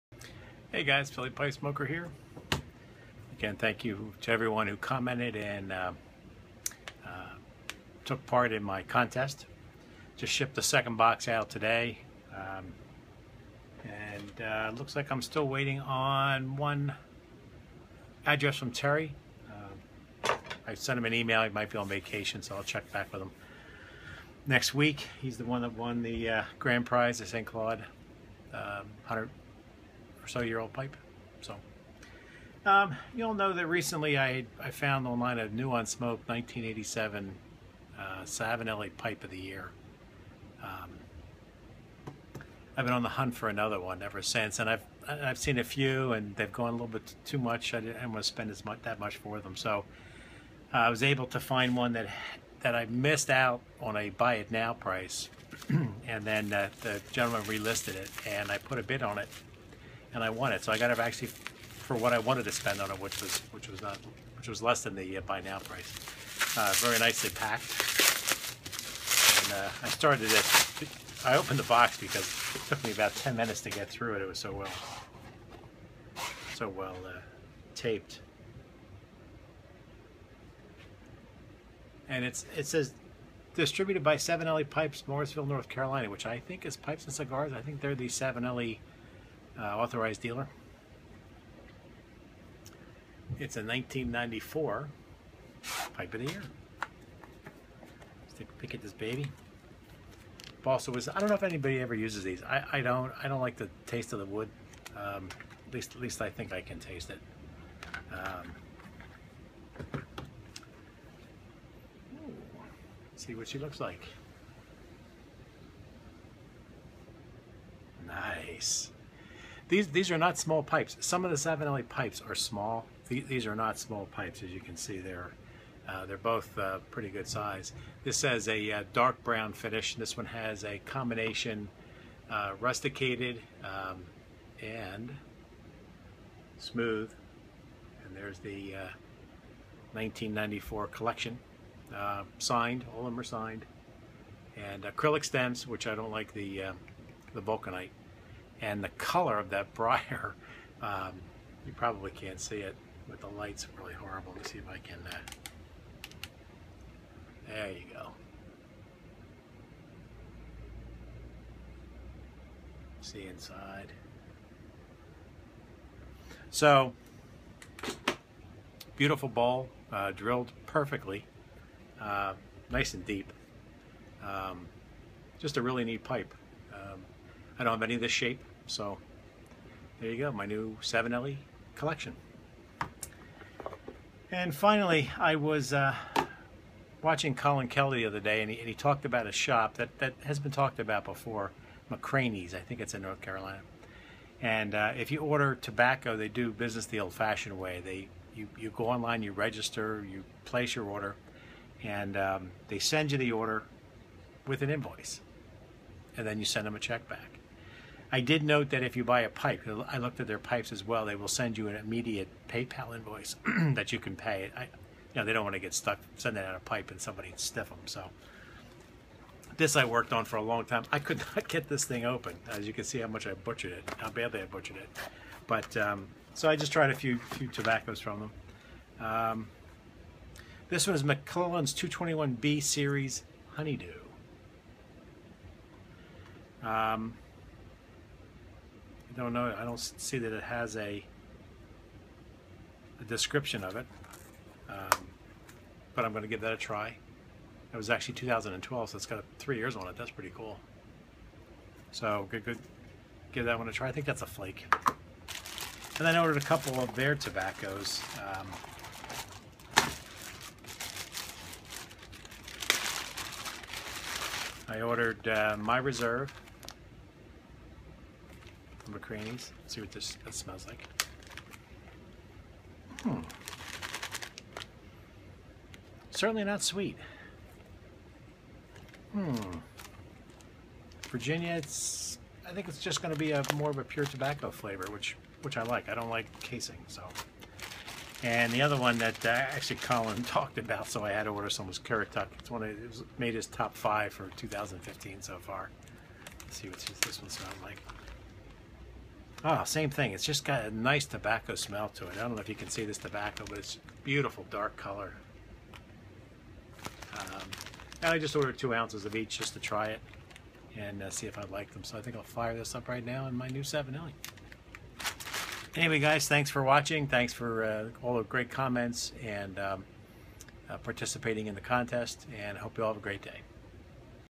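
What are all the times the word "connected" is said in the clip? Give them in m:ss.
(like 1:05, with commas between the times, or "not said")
not said.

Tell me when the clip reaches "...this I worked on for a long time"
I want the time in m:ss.
3:39.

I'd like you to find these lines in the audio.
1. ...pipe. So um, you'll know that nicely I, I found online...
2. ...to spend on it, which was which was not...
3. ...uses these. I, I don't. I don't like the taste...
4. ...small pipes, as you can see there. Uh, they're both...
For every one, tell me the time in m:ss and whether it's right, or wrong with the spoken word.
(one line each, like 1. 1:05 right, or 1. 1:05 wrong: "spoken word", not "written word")
1. 0:30 wrong: "recently", not "nicely"
2. 1:02 right
3. 1:41 right
4. 2:03 right.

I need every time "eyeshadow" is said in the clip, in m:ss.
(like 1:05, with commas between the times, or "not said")
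not said.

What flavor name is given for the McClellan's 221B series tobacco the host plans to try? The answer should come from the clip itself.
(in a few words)
Honeydew.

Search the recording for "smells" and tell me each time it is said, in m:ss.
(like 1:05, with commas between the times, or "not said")
4:30, 4:57, 5:01.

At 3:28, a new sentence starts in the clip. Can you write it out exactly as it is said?
I did note that if you buy a pipe, I looked at their pipes as well.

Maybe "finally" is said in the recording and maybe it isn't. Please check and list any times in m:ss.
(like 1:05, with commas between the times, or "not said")
3:04.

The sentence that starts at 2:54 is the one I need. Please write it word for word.
Um, just a really neat pipe.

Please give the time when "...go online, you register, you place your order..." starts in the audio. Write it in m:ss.
3:18.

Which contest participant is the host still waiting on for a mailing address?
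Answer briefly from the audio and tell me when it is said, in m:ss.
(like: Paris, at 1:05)
Terry, at 0:18.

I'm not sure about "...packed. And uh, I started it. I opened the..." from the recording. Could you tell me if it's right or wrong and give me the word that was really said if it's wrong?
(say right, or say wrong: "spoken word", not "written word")
right.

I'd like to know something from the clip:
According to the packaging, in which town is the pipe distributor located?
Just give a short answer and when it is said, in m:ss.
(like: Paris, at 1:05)
Morrisville, North Carolina, at 1:25.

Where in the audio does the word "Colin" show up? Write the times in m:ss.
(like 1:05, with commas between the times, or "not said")
3:07, 4:49.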